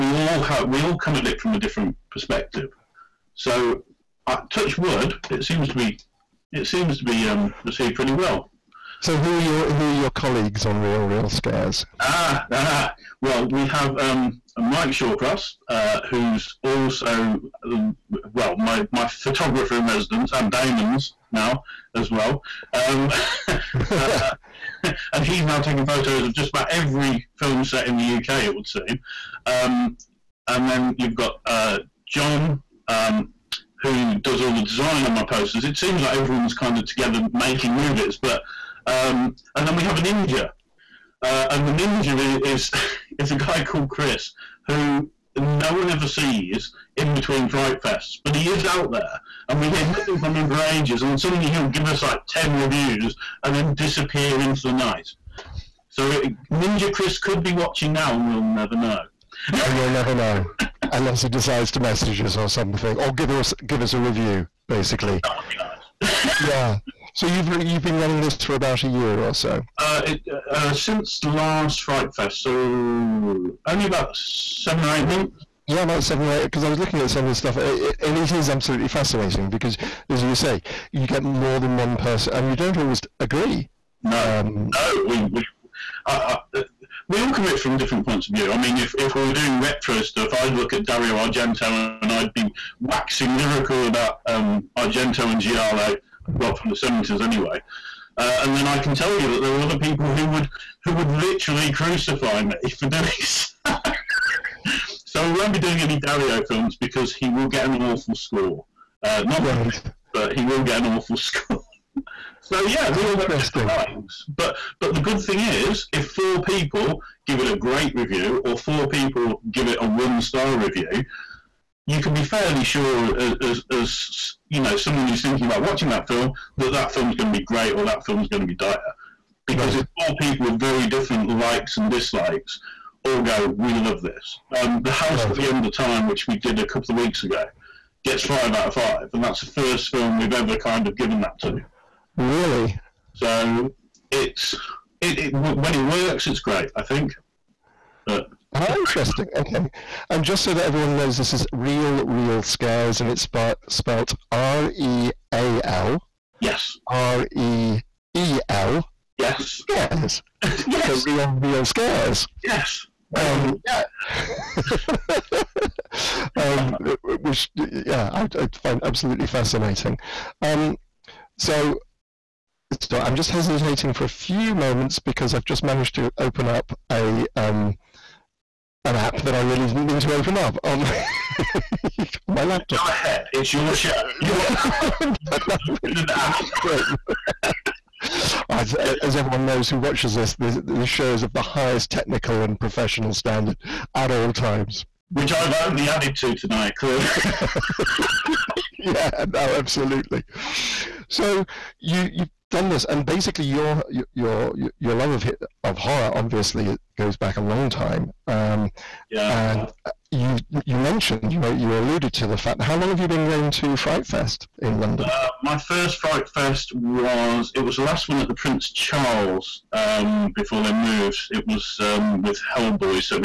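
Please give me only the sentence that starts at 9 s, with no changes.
So, who are your who are your colleagues on Real Reel Scares?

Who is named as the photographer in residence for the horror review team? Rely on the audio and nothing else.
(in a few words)
Mike Shawcross.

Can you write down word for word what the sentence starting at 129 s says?
it's four people with very different likes and dislikes all go, we love this.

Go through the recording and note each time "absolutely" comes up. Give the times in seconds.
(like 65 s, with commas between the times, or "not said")
78 s, 168 s, 199 s.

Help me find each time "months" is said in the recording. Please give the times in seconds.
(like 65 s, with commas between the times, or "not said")
75 s.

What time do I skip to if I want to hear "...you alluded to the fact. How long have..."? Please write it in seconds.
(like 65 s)
211 s.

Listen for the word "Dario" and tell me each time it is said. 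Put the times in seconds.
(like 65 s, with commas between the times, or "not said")
90 s, 106 s.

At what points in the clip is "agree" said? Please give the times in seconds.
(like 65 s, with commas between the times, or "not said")
83 s.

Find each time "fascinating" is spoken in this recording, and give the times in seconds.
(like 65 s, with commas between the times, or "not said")
78 s, 169 s.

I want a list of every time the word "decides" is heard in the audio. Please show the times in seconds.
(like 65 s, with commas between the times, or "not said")
61 s.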